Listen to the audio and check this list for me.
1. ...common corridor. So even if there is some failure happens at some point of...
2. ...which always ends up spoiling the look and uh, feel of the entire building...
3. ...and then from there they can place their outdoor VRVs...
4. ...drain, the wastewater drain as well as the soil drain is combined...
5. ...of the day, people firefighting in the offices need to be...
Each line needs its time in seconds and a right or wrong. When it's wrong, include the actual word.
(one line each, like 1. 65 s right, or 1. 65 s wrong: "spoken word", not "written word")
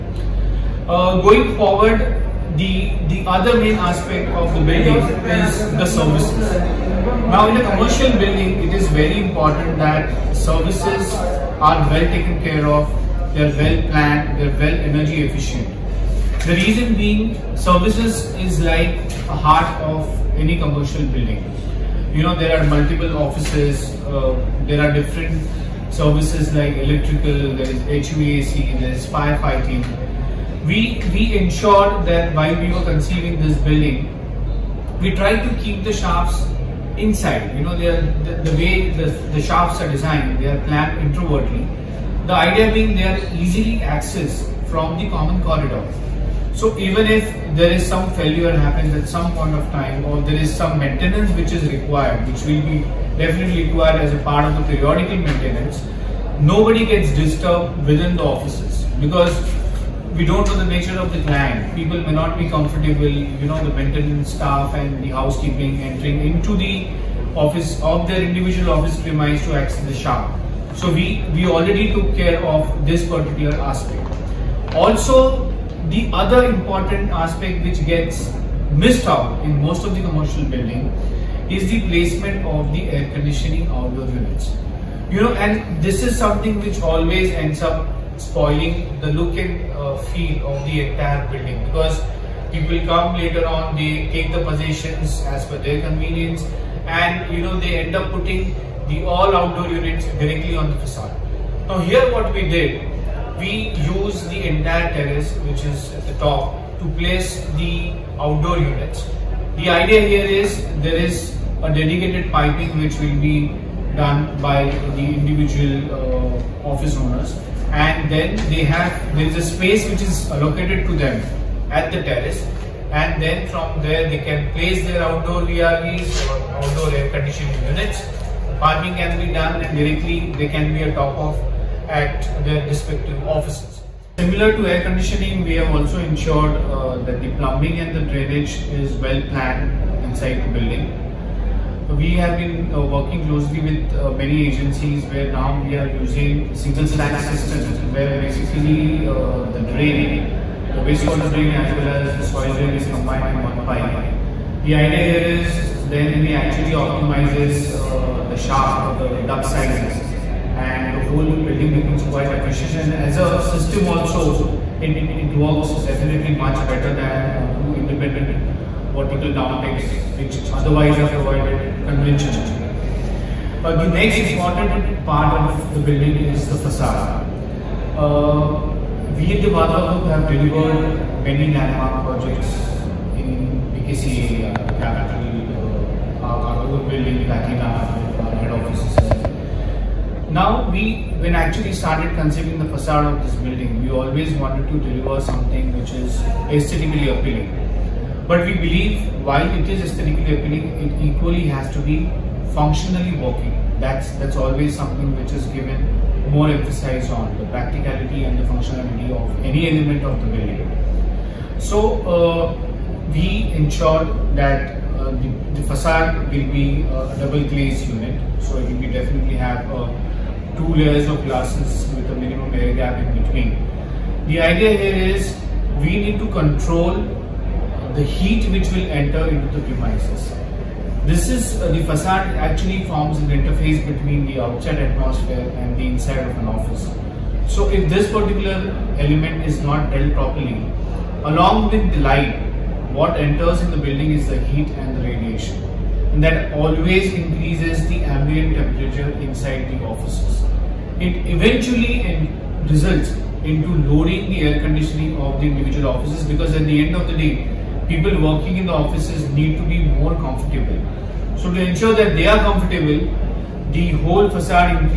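1. 45 s right
2. 86 s right
3. 122 s right
4. 149 s right
5. 256 s wrong: "working", not "firefighting".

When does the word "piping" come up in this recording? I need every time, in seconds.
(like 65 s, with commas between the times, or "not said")
112 s, 128 s.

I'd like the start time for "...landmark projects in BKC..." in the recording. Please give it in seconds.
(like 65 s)
181 s.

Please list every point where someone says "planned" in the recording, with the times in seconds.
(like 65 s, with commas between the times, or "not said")
13 s, 40 s, 139 s.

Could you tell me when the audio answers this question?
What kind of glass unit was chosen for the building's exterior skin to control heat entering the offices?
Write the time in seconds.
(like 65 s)
217 s.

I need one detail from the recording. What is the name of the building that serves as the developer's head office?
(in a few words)
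Platina.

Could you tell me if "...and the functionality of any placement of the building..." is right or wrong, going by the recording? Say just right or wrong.
wrong.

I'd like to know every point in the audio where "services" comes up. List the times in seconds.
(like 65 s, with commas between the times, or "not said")
5 s, 10 s, 17 s, 25 s.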